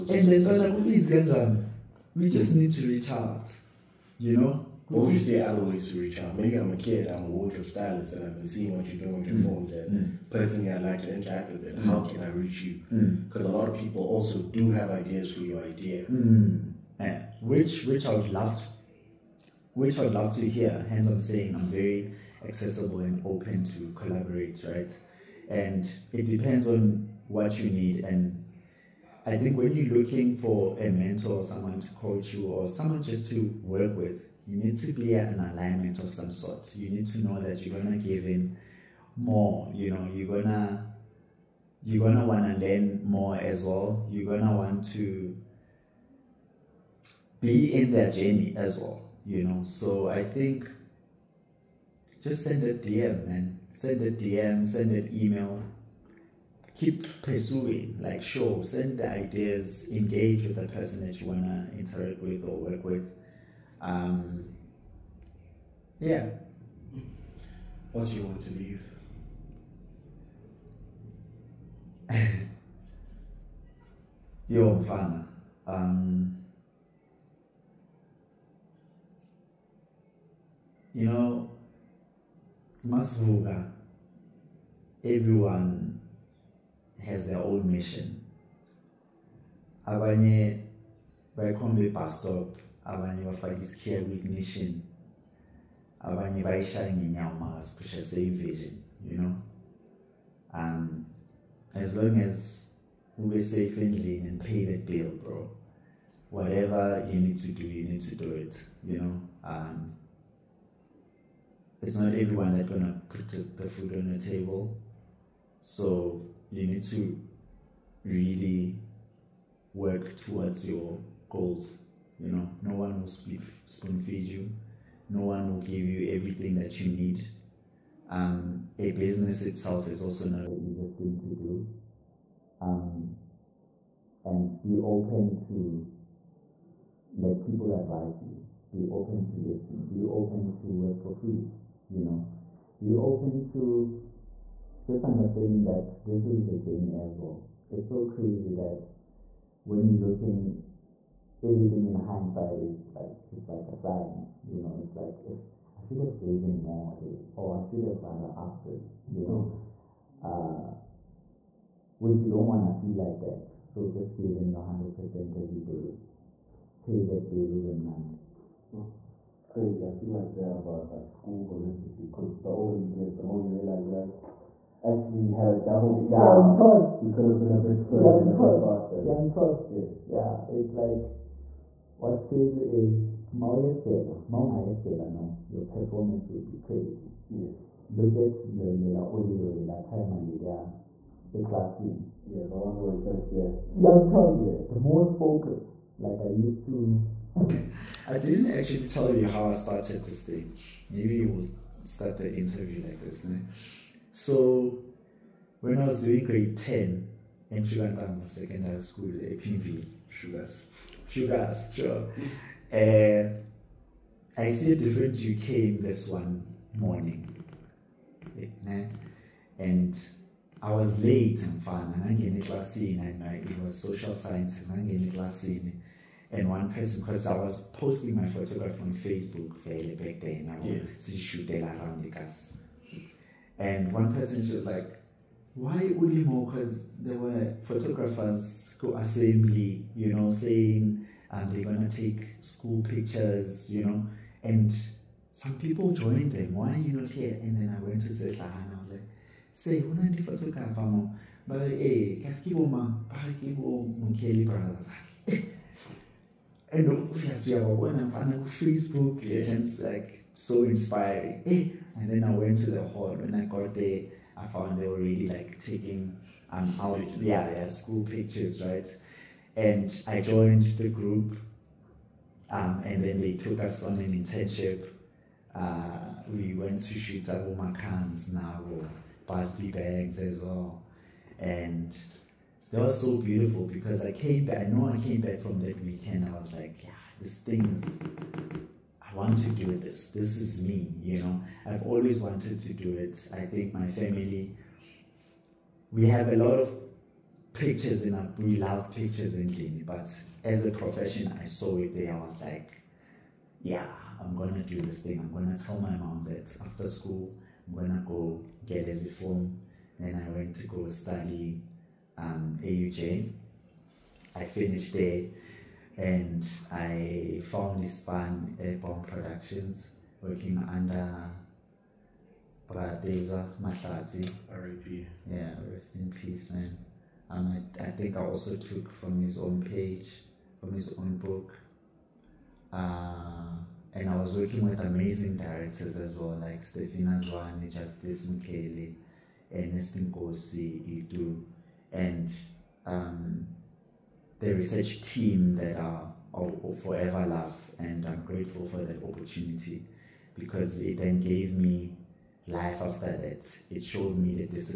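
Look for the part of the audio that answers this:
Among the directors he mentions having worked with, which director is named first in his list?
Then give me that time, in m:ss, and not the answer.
5:36.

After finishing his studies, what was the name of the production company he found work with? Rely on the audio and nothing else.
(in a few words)
Bomb Productions.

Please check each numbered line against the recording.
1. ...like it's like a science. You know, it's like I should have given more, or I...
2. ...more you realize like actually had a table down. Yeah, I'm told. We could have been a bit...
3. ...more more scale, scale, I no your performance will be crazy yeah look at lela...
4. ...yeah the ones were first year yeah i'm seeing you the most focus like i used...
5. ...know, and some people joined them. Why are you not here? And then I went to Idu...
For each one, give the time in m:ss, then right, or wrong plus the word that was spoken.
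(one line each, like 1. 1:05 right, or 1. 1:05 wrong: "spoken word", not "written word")
1. 2:32 right
2. 2:53 wrong: "double", not "table"
3. 3:03 right
4. 3:12 wrong: "telling", not "seeing"
5. 4:03 wrong: "Zetla", not "Idu".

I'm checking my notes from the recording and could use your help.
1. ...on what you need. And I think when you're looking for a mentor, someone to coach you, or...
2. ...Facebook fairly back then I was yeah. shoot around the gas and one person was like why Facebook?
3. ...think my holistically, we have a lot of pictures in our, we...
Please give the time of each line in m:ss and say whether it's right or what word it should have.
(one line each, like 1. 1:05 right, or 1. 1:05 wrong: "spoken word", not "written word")
1. 0:26 right
2. 3:48 wrong: "Ulimo", not "Facebook"
3. 4:53 wrong: "family", not "holistically".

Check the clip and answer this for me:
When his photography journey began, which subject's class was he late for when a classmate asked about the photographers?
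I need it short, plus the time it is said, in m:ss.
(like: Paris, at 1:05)
Social sciences, at 3:43.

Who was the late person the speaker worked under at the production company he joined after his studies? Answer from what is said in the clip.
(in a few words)
Bradeza Mashazi.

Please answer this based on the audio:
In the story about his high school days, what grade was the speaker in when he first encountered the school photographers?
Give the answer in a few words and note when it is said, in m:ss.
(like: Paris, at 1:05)
Grade 10, at 3:26.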